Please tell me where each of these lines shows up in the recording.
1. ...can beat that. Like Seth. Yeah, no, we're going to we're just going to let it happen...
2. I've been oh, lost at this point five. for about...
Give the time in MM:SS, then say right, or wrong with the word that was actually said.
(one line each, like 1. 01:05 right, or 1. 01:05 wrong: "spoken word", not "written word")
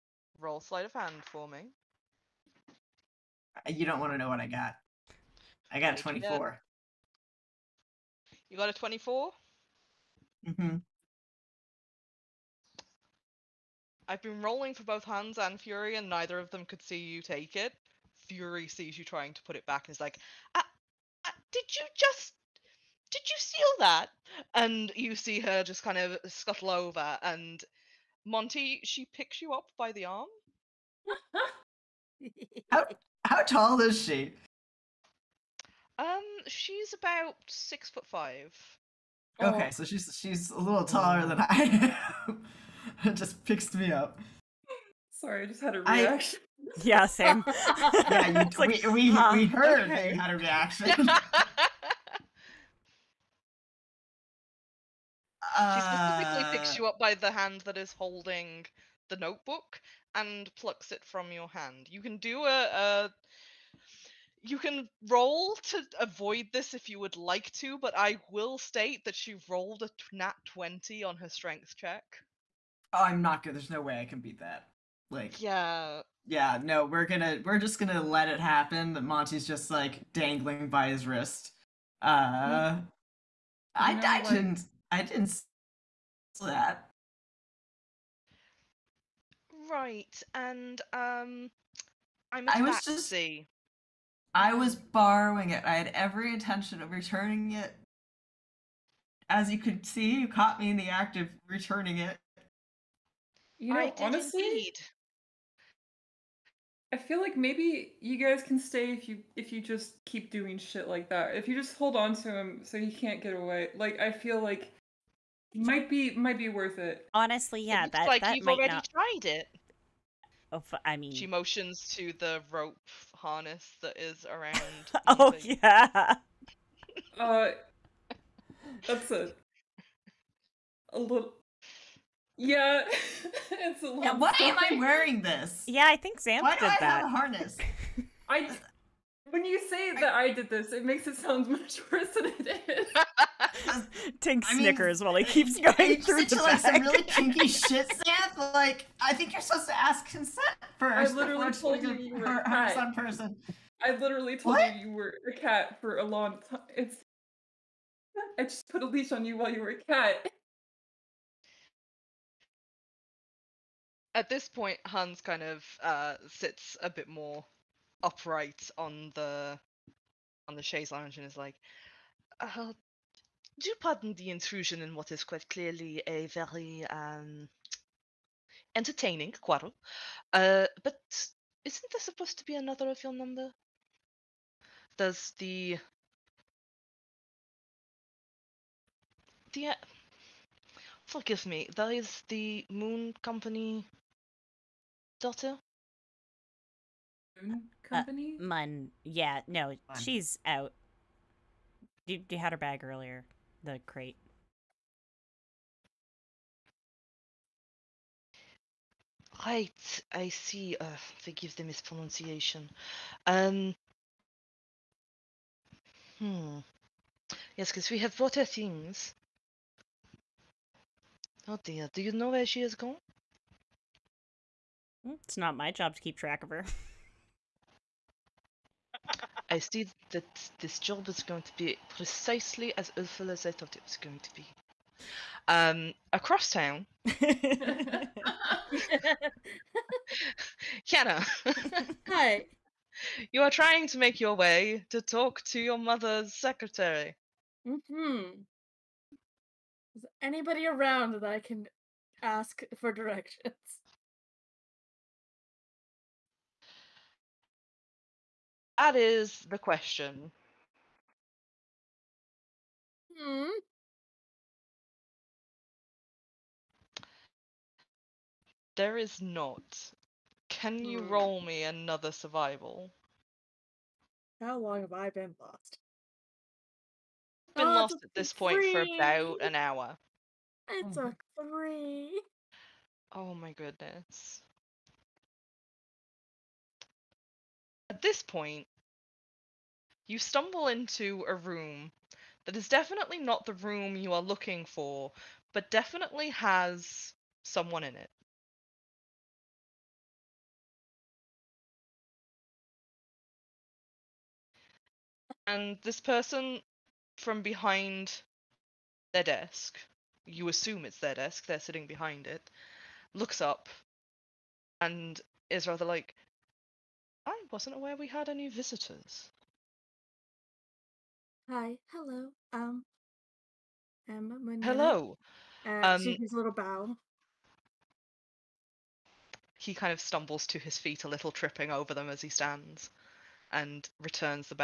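1. 01:14 wrong: "Yeah", not "Seth"
2. 04:37 wrong: "three", not "five".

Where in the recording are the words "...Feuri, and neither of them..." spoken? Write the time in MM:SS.
00:15.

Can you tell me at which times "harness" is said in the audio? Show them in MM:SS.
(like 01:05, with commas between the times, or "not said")
02:03, 02:17.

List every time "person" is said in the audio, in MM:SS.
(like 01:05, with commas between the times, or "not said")
02:32, 05:06.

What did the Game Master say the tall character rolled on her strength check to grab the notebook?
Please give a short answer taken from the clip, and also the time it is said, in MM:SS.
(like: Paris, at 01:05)
nat 20, at 01:10.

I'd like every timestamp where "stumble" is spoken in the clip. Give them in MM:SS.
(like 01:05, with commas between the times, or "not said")
04:50, 05:30.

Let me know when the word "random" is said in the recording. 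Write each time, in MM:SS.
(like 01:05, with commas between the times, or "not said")
not said.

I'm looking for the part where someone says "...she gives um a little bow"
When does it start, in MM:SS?
05:25.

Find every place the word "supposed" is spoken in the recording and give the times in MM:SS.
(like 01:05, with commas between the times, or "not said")
02:29, 03:02.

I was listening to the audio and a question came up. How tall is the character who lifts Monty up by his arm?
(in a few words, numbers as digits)
six foot five.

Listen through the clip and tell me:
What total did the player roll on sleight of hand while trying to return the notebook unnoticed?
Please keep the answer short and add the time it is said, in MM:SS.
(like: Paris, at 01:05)
24, at 00:05.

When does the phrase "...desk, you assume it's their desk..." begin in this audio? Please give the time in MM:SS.
05:09.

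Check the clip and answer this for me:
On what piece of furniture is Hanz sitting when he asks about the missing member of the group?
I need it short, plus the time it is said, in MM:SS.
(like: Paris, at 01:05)
chaise lounge, at 02:50.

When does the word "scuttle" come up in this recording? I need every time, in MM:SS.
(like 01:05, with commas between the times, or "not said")
00:26.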